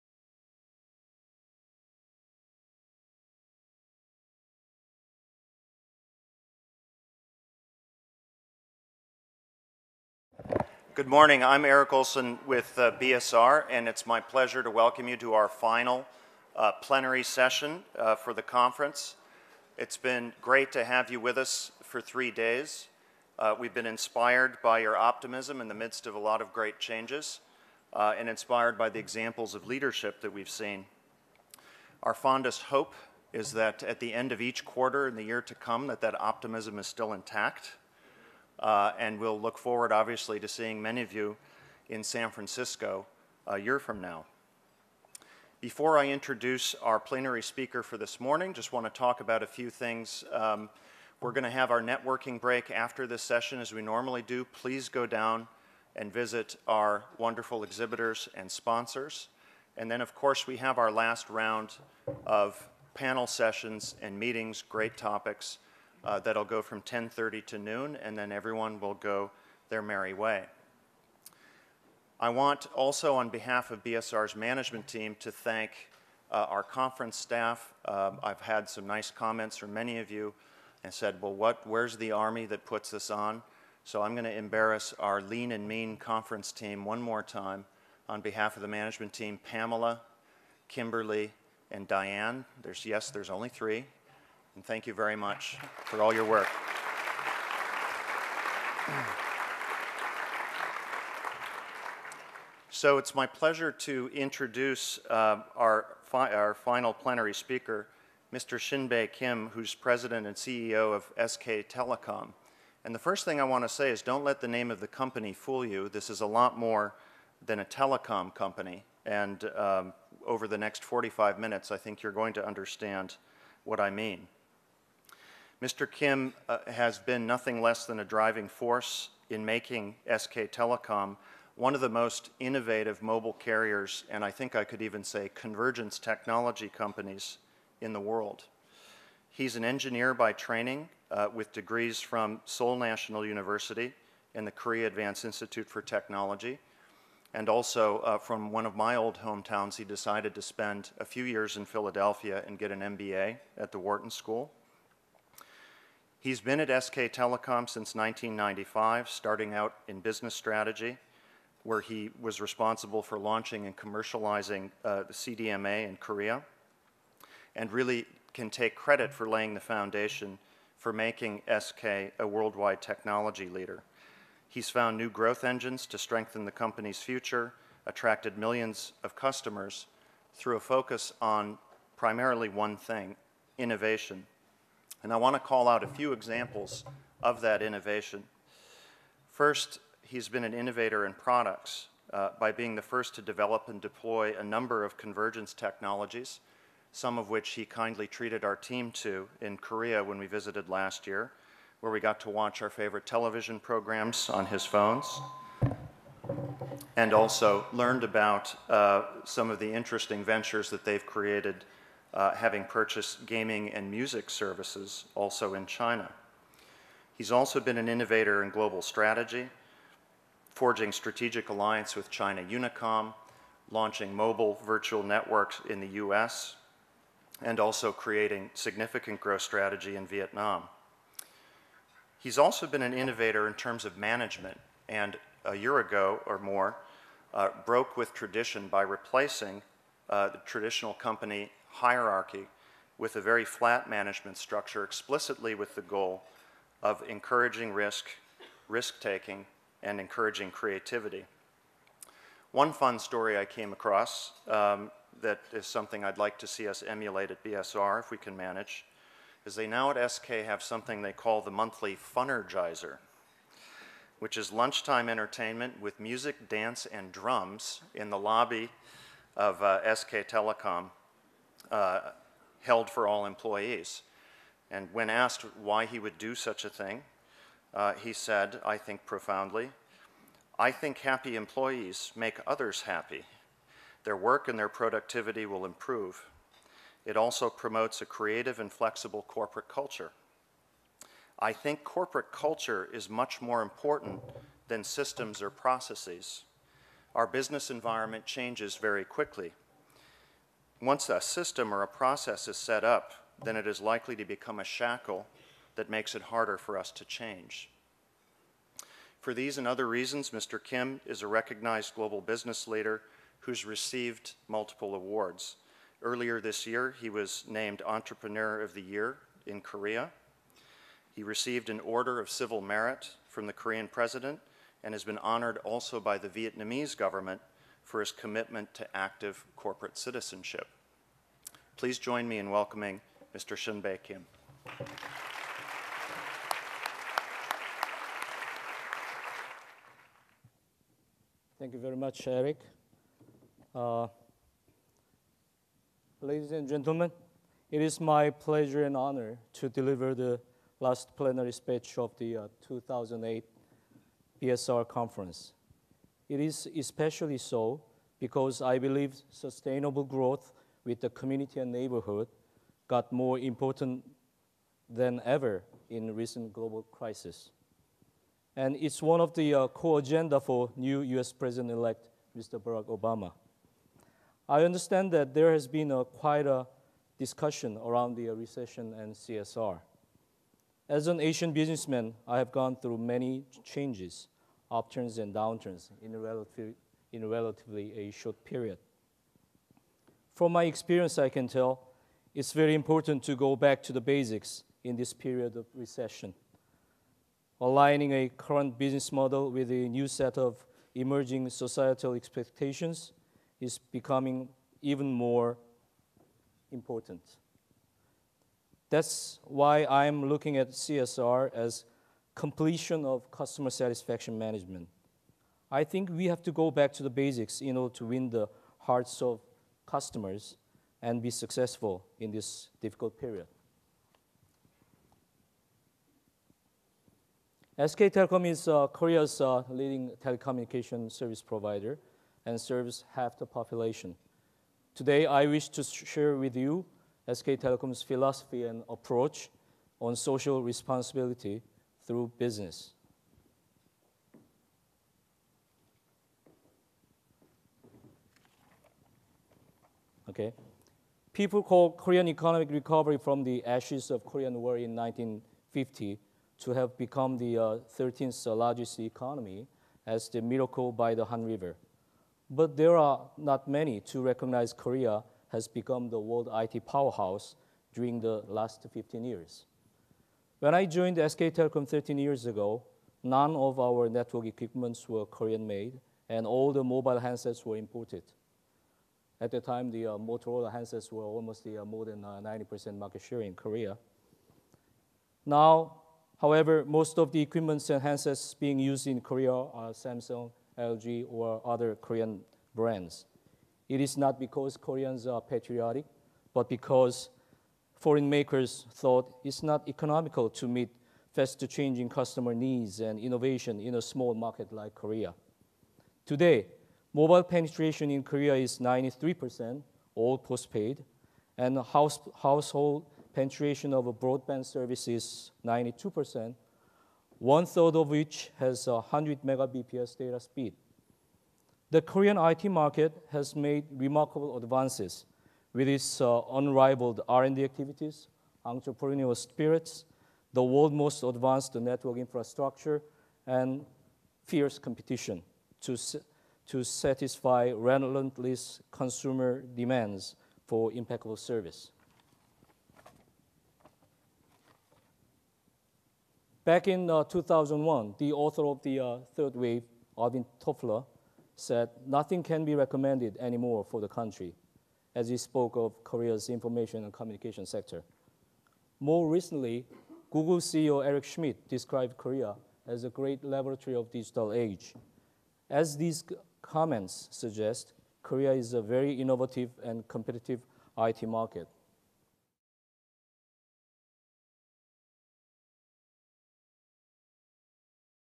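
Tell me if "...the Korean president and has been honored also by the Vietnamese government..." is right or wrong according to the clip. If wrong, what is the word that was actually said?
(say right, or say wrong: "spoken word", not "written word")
right.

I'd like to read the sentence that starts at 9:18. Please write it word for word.
More recently, Google CEO Eric Schmidt described Korea as a great laboratory of digital age.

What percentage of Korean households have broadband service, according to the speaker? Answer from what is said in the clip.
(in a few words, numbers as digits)
92%.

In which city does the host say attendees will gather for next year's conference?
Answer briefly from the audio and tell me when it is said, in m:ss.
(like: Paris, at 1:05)
San Francisco, at 0:42.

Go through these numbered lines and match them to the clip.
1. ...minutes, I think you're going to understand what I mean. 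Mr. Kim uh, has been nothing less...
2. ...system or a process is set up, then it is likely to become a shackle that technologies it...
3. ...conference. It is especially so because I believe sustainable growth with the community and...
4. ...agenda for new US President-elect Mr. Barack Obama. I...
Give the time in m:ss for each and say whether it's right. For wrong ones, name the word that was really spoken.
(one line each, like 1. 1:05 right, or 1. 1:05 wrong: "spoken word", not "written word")
1. 2:01 right
2. 5:01 wrong: "makes", not "technologies"
3. 5:54 right
4. 6:09 right.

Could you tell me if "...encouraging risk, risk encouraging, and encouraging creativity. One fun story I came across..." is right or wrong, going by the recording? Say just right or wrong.
wrong.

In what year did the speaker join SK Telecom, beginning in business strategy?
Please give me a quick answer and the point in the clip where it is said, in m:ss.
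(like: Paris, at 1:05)
1995, at 2:37.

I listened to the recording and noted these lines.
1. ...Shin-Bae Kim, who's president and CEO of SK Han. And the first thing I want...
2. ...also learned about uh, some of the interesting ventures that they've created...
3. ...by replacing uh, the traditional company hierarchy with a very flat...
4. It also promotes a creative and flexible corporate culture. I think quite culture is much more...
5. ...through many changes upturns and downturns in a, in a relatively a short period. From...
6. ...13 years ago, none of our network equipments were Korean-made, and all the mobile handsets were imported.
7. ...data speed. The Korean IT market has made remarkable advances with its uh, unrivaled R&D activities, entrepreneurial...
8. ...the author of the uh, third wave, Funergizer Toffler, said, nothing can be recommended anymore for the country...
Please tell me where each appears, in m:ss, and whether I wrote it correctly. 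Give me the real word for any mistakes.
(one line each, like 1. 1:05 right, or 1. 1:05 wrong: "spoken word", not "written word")
1. 1:48 wrong: "Telecom", not "Han"
2. 3:27 right
3. 3:58 right
4. 4:47 wrong: "corporate", not "quite"
5. 6:22 right
6. 7:51 right
7. 8:40 right
8. 9:08 wrong: "Alvin", not "Funergizer".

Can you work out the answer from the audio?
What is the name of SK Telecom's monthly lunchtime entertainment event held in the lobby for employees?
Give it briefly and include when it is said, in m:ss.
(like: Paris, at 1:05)
Funergizer, at 4:22.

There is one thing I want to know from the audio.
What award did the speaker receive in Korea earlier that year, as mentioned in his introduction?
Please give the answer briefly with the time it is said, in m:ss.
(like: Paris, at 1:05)
Entrepreneur of the Year, at 5:17.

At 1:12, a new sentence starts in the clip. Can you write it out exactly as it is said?
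I want also on behalf of BSR's management team to thank uh, our conference staff.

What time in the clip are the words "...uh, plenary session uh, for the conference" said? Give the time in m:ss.
0:16.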